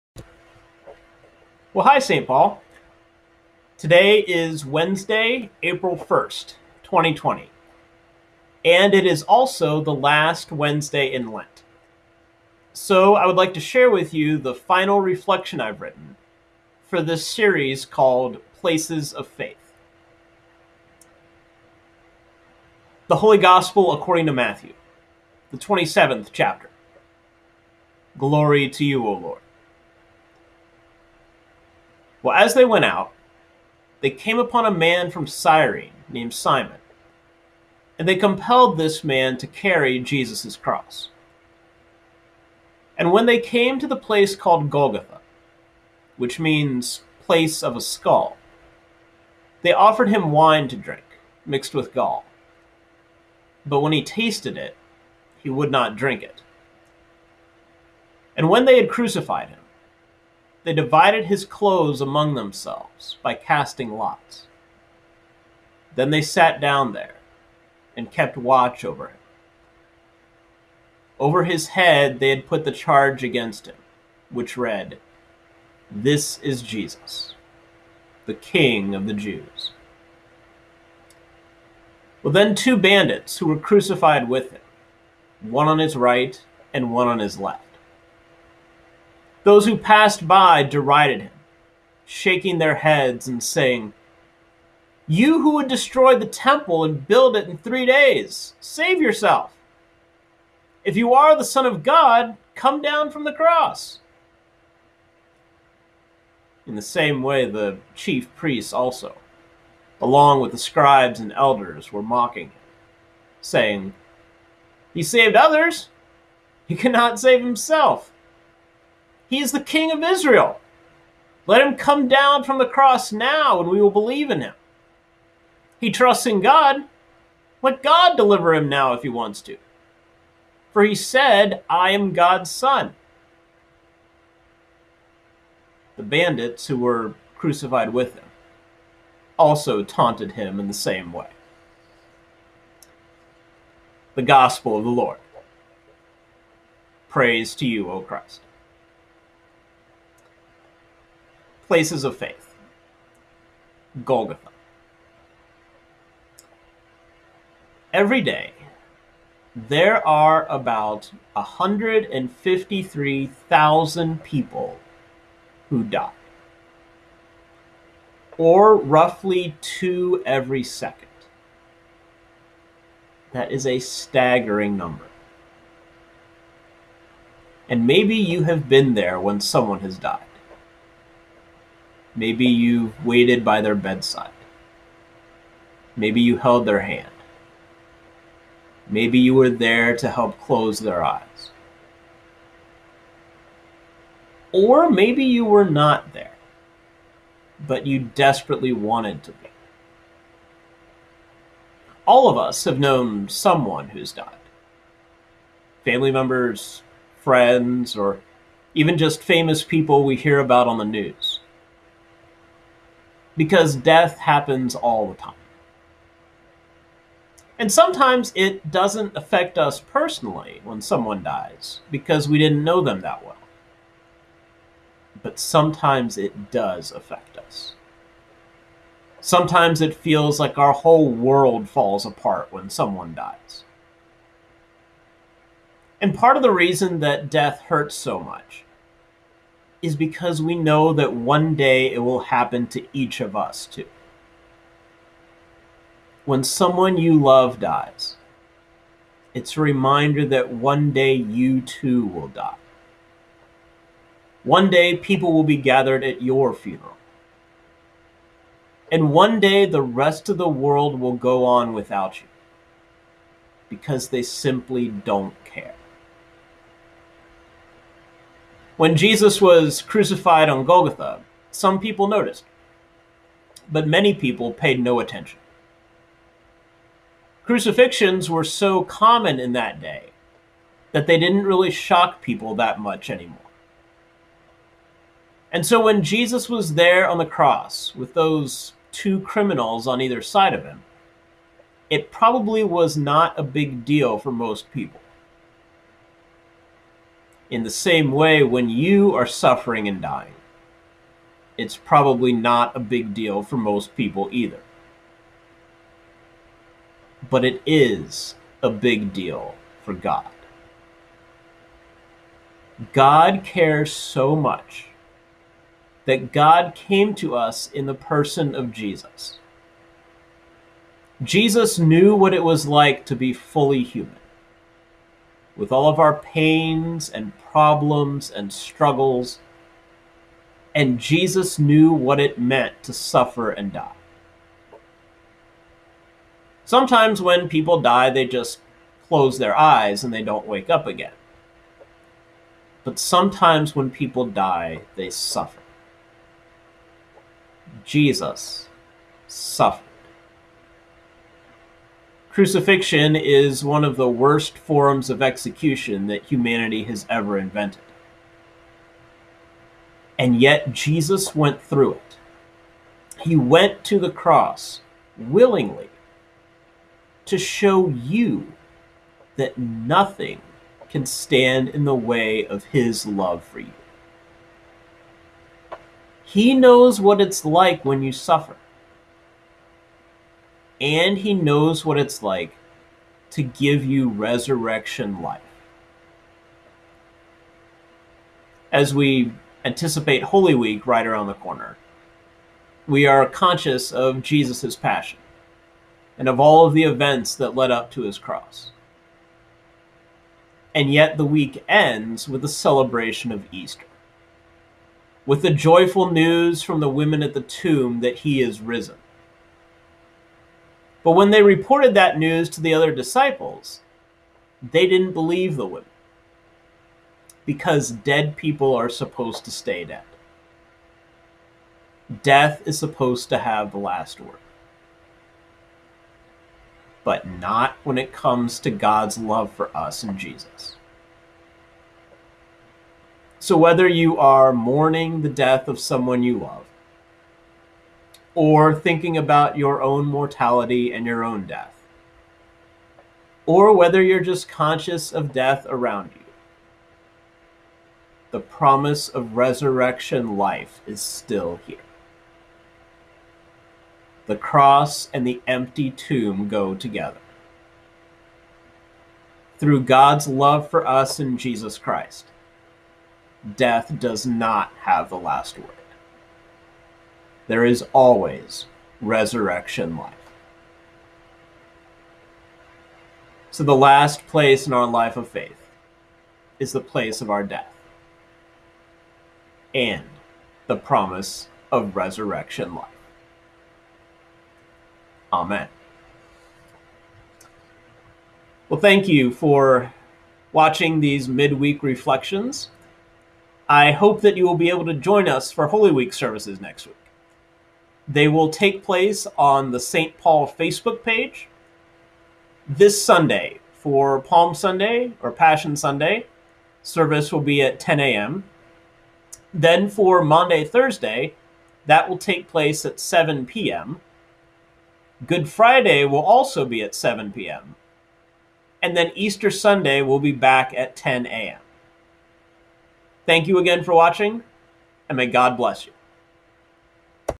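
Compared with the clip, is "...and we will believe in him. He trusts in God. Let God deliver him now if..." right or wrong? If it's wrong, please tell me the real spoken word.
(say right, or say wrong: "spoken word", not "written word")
right.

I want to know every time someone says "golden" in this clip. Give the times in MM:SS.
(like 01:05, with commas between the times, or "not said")
not said.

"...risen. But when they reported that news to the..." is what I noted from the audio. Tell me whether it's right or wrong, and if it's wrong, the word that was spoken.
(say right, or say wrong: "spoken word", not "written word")
right.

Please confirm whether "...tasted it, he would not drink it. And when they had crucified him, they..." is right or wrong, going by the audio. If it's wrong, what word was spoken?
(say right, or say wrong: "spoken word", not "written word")
right.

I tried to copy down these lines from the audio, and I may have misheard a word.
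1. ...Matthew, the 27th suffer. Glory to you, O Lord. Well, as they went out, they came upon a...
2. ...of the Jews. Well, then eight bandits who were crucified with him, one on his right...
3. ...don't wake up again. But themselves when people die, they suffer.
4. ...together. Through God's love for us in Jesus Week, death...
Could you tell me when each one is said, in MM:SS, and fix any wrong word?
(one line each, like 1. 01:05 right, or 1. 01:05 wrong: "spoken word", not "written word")
1. 00:24 wrong: "chapter", not "suffer"
2. 01:18 wrong: "two", not "eight"
3. 05:40 wrong: "sometimes", not "themselves"
4. 07:36 wrong: "Christ", not "Week".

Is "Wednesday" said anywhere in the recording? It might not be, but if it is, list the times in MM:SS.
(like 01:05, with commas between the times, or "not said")
00:04, 00:10.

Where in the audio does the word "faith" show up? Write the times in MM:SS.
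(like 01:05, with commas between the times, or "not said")
00:19, 02:32, 07:55.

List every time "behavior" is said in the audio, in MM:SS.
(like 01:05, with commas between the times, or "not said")
not said.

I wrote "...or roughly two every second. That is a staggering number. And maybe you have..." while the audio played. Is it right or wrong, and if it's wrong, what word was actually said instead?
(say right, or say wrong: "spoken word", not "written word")
right.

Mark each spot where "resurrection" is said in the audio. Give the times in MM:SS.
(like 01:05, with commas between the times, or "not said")
06:24, 07:29, 07:49, 08:01.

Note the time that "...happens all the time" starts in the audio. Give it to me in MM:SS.
03:34.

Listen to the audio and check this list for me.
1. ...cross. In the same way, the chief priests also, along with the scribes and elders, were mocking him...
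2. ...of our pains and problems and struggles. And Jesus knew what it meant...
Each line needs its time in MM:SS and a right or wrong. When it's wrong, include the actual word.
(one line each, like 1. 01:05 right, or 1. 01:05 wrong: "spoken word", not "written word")
1. 01:43 right
2. 05:25 right.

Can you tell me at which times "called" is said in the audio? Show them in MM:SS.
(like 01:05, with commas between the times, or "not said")
00:17, 00:44.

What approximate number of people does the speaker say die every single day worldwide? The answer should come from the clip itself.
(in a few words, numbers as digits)
153,000.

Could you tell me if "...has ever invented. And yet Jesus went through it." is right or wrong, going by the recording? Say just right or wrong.
right.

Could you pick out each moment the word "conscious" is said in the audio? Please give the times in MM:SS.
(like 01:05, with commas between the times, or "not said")
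06:33, 07:24.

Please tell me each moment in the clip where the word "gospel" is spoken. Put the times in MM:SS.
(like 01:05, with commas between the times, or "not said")
00:23, 02:24.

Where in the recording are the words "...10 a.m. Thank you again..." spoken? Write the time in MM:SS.
08:40.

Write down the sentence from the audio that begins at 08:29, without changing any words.
Then for Maundy, Thursday, that will take place at 7 p.m.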